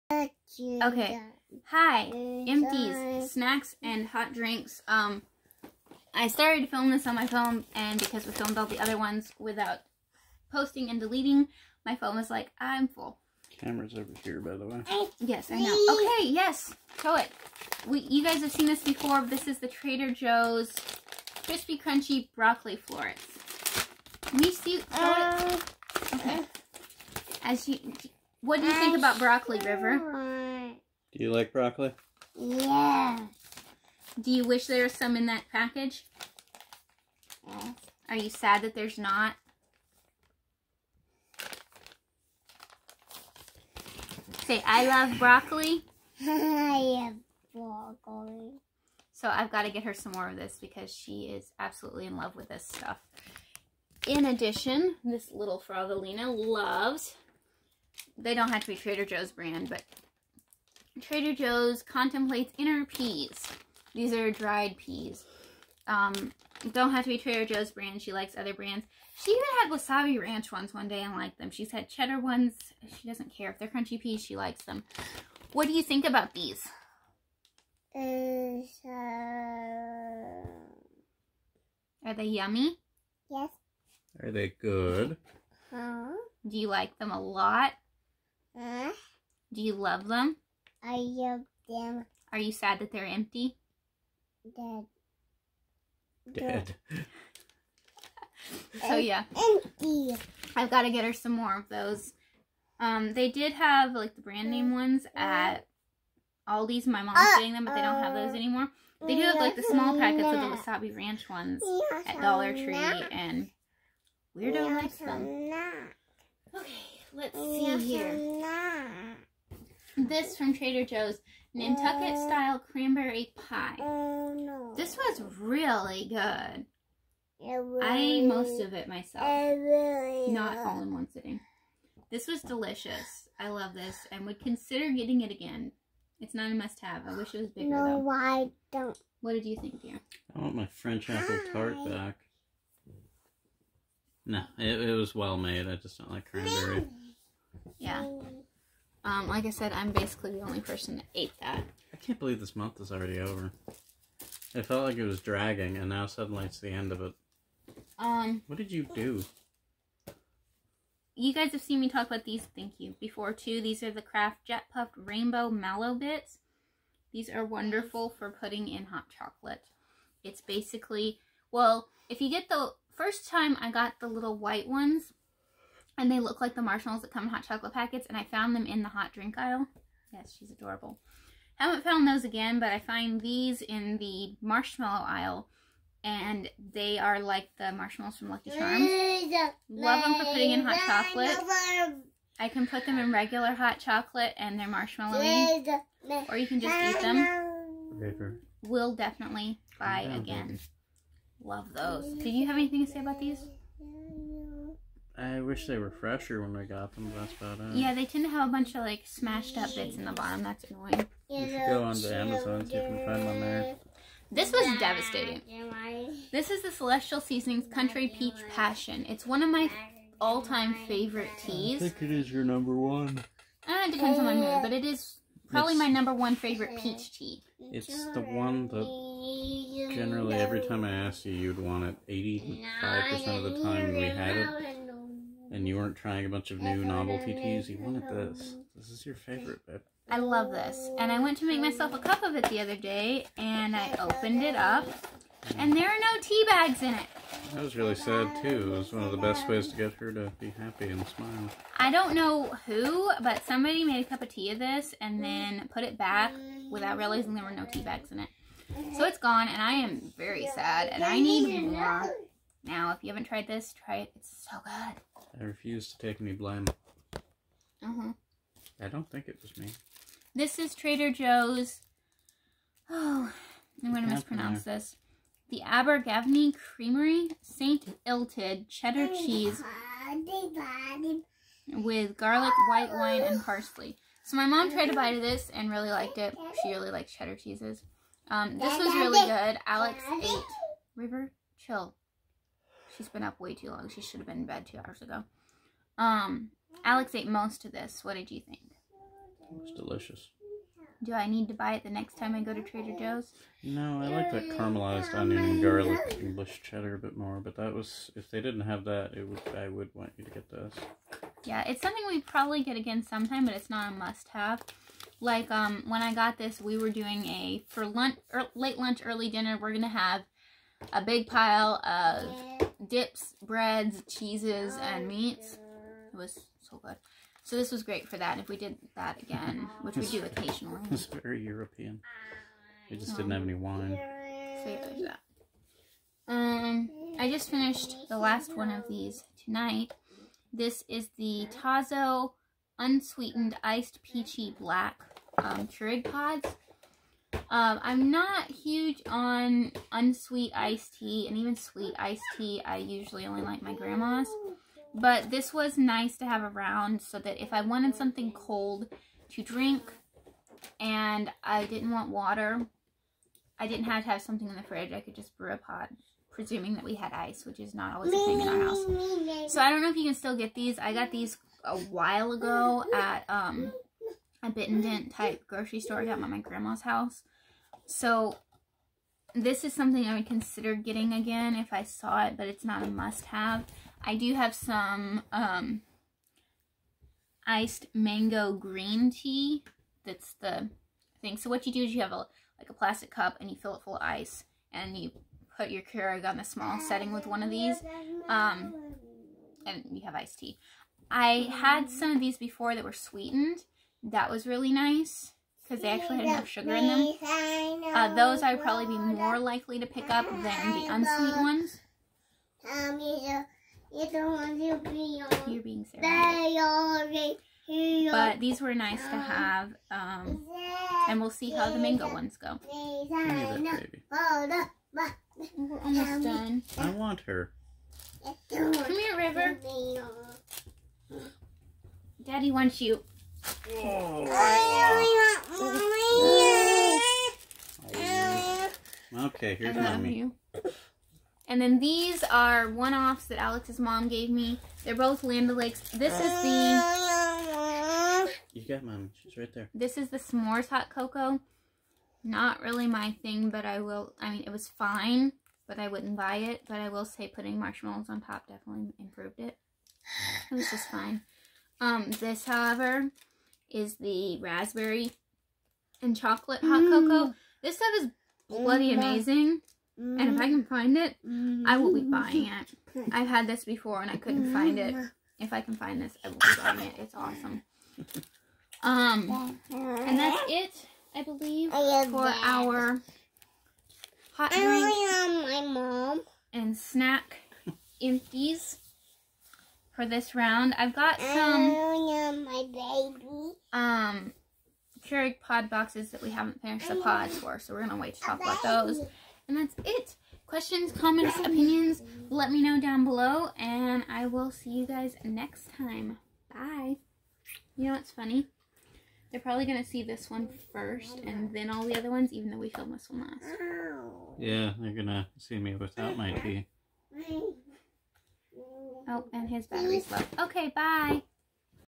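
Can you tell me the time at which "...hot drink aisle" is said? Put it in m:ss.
2:58.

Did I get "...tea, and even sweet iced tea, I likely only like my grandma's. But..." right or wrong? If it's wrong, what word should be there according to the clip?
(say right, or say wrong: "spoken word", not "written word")
wrong: "usually", not "likely".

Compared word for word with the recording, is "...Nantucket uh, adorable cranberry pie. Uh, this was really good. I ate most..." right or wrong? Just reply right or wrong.
wrong.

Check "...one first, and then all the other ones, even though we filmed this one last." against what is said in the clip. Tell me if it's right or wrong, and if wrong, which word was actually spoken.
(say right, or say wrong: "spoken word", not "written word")
right.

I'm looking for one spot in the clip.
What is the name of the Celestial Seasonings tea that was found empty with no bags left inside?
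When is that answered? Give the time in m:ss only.
3:37.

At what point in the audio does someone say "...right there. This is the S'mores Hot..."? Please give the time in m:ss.
7:29.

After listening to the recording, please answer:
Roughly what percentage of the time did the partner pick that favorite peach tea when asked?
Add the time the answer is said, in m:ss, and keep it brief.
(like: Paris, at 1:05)
85%, at 3:52.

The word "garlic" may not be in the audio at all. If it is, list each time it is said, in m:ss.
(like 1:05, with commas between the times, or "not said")
4:42, 5:05.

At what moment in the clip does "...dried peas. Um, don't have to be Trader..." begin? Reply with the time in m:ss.
1:04.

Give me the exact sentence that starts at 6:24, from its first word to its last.
I do have some um, iced mango green tea.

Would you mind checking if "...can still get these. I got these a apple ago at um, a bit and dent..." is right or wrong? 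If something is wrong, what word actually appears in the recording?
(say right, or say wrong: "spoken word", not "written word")
wrong: "while", not "apple".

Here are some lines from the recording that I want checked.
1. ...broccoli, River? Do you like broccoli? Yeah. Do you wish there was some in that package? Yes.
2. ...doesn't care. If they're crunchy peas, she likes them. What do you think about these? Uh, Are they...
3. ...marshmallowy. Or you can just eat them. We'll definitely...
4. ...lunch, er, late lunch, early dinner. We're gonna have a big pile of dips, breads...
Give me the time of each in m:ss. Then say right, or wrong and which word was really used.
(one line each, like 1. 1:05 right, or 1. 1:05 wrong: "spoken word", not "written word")
1. 0:29 right
2. 1:13 right
3. 3:14 right
4. 5:17 right.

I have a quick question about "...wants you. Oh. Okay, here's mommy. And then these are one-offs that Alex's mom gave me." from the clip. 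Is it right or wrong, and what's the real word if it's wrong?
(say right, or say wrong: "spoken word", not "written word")
right.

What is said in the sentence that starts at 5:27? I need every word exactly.
So this was great for that.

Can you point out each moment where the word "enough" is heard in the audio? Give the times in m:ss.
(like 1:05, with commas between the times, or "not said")
6:46.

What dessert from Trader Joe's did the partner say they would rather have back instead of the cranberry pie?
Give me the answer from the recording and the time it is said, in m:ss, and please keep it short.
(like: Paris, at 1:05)
French apple tart, at 2:20.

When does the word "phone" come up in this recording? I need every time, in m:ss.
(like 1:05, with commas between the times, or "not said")
0:07, 0:11.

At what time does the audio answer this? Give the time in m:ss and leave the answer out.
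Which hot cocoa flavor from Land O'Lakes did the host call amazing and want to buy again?
7:44.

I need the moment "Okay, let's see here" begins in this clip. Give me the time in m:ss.
1:56.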